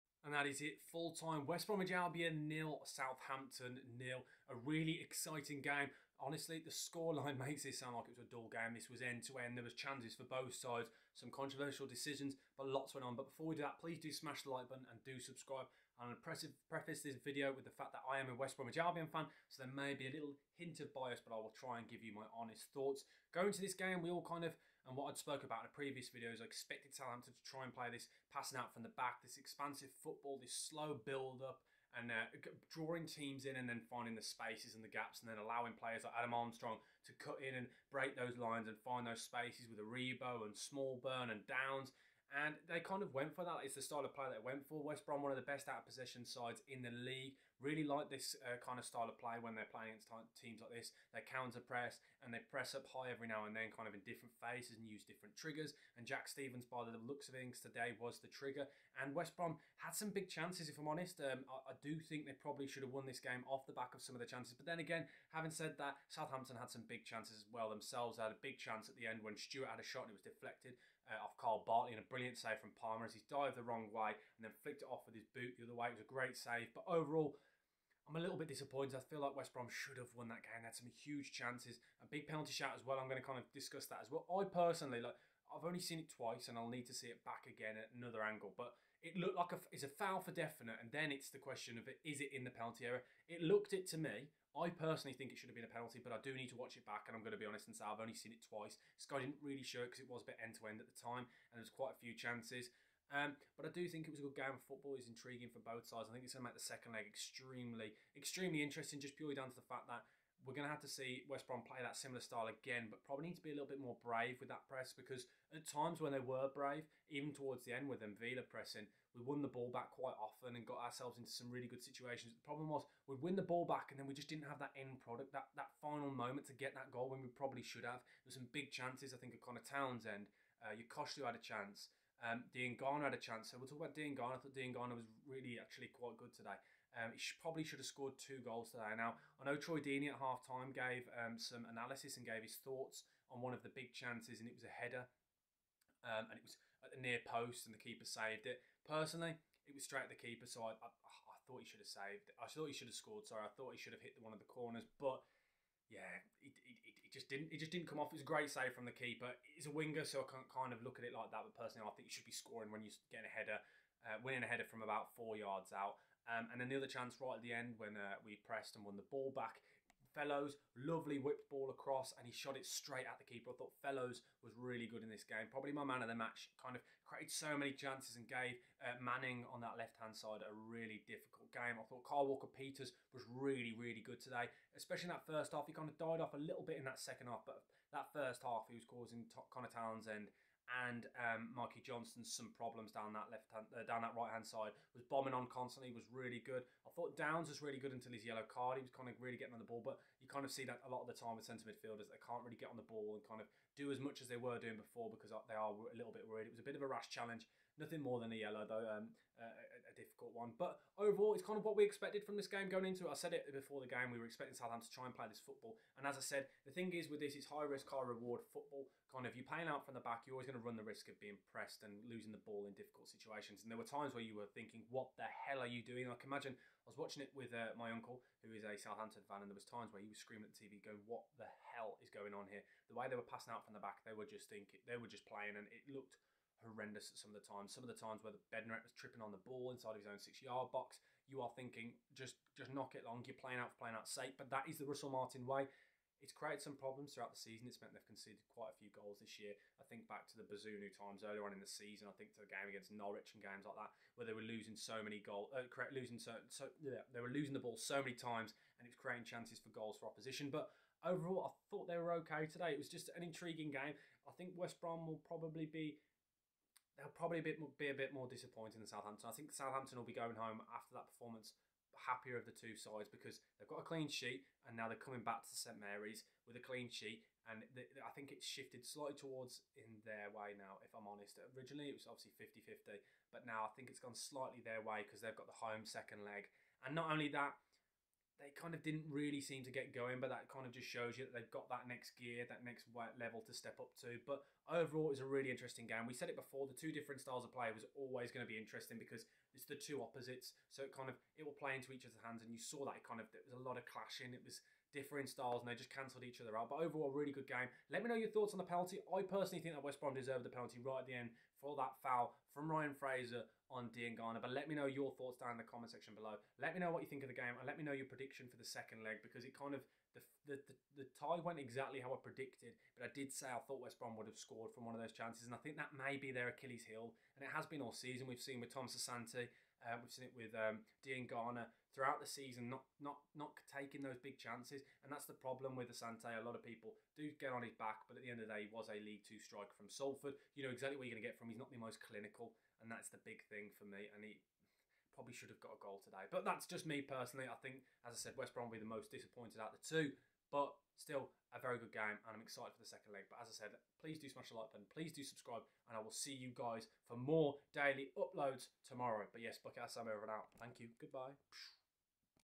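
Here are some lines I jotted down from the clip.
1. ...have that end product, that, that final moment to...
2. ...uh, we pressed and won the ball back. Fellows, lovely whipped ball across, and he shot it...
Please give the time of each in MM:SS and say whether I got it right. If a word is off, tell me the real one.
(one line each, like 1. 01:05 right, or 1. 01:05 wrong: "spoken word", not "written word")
1. 02:04 right
2. 02:47 right.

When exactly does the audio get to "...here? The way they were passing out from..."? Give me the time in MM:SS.
03:52.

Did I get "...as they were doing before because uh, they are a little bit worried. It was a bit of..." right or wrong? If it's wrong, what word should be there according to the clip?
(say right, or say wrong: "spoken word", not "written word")
right.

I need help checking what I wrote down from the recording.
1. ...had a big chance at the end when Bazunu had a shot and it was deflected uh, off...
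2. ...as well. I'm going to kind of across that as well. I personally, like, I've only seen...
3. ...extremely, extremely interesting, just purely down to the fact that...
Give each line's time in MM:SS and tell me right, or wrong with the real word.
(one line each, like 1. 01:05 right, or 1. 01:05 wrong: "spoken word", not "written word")
1. 01:08 wrong: "Stewart", not "Bazunu"
2. 01:22 wrong: "discuss", not "across"
3. 01:47 right.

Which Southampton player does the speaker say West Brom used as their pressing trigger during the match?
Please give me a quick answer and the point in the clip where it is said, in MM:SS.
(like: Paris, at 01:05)
Jack Stephens, at 00:56.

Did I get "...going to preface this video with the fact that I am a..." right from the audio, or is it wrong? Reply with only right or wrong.
right.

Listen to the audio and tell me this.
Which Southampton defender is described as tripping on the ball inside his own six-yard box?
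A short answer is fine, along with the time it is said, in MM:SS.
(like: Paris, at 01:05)
Bednarek, at 03:58.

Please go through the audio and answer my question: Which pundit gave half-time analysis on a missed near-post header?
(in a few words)
Troy Deeney.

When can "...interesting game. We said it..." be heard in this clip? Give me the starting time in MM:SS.
04:55.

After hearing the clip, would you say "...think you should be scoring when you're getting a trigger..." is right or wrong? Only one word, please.
wrong.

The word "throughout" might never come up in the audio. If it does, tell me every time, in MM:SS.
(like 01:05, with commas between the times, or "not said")
04:07, 05:31.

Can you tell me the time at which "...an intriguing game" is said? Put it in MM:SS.
04:23.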